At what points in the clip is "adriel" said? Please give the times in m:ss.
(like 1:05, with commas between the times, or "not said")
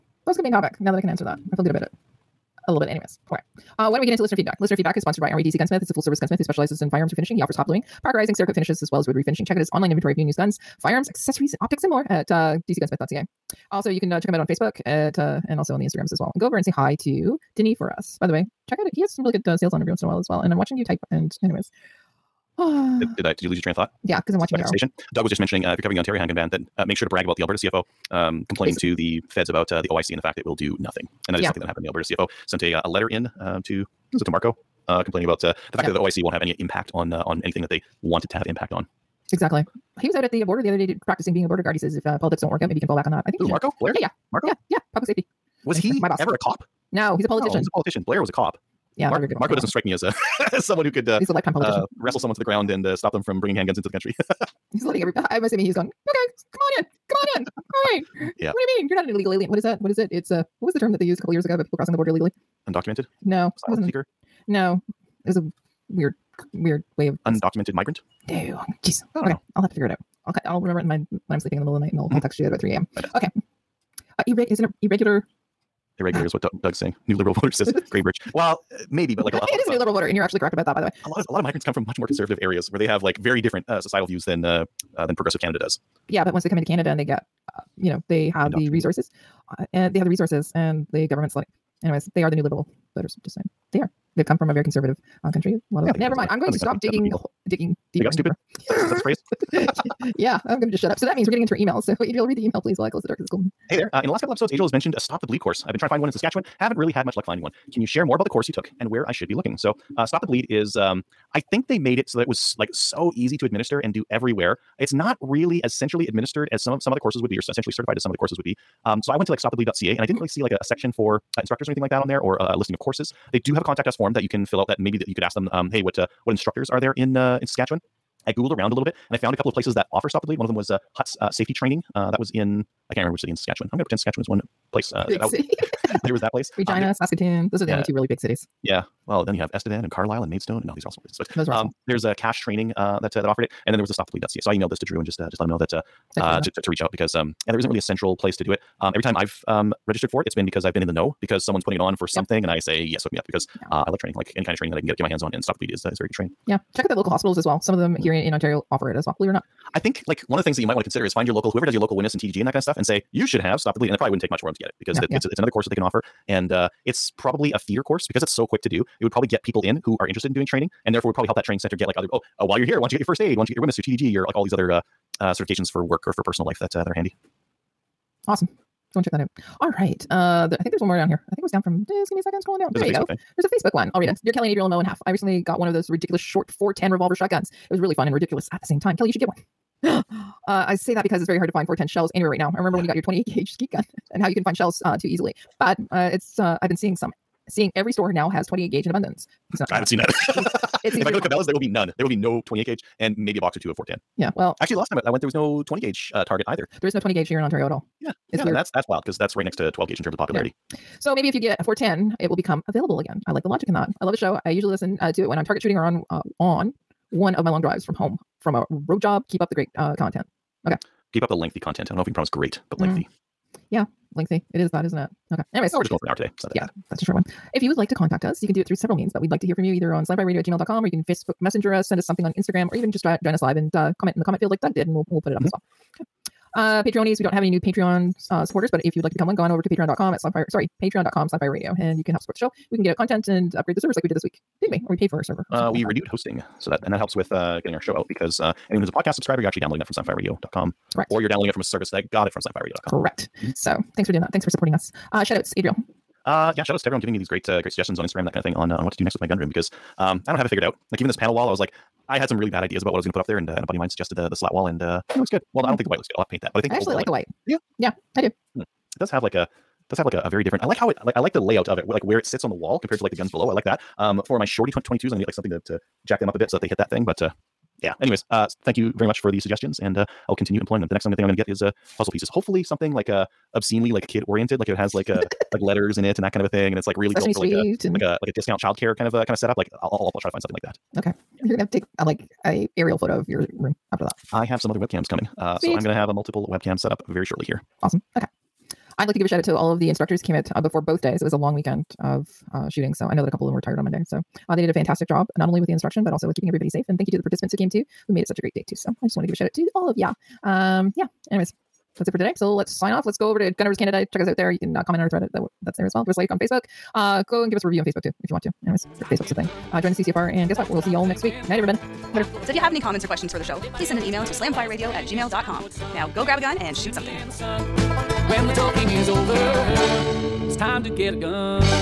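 1:42, 3:04, 4:15.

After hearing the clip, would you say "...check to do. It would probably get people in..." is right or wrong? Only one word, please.
wrong.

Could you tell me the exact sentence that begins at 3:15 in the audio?
But uh, it's uh, I've been seeing some, seeing every store now has 28 gauge in abundance.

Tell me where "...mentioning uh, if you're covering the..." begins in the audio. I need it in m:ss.
0:25.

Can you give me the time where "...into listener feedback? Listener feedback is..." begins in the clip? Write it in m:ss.
0:04.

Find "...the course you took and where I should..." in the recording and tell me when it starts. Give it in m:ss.
1:48.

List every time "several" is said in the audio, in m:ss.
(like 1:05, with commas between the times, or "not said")
3:48.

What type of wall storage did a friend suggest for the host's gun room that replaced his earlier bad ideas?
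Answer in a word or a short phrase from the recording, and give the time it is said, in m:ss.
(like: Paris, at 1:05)
Slat wall, at 4:24.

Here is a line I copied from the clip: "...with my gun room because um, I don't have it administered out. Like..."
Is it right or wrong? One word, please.
wrong.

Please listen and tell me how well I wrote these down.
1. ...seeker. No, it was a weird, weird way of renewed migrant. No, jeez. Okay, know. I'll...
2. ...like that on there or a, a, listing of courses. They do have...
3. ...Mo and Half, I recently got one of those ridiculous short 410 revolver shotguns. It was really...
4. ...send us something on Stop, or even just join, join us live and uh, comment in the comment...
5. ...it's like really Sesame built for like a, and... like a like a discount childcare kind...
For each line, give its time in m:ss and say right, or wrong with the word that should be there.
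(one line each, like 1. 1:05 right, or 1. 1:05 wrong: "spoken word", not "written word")
1. 1:03 wrong: "undocumented", not "renewed"
2. 2:01 right
3. 3:04 right
4. 3:51 wrong: "Instagram", not "Stop"
5. 4:46 right.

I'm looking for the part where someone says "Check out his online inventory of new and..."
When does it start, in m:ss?
0:09.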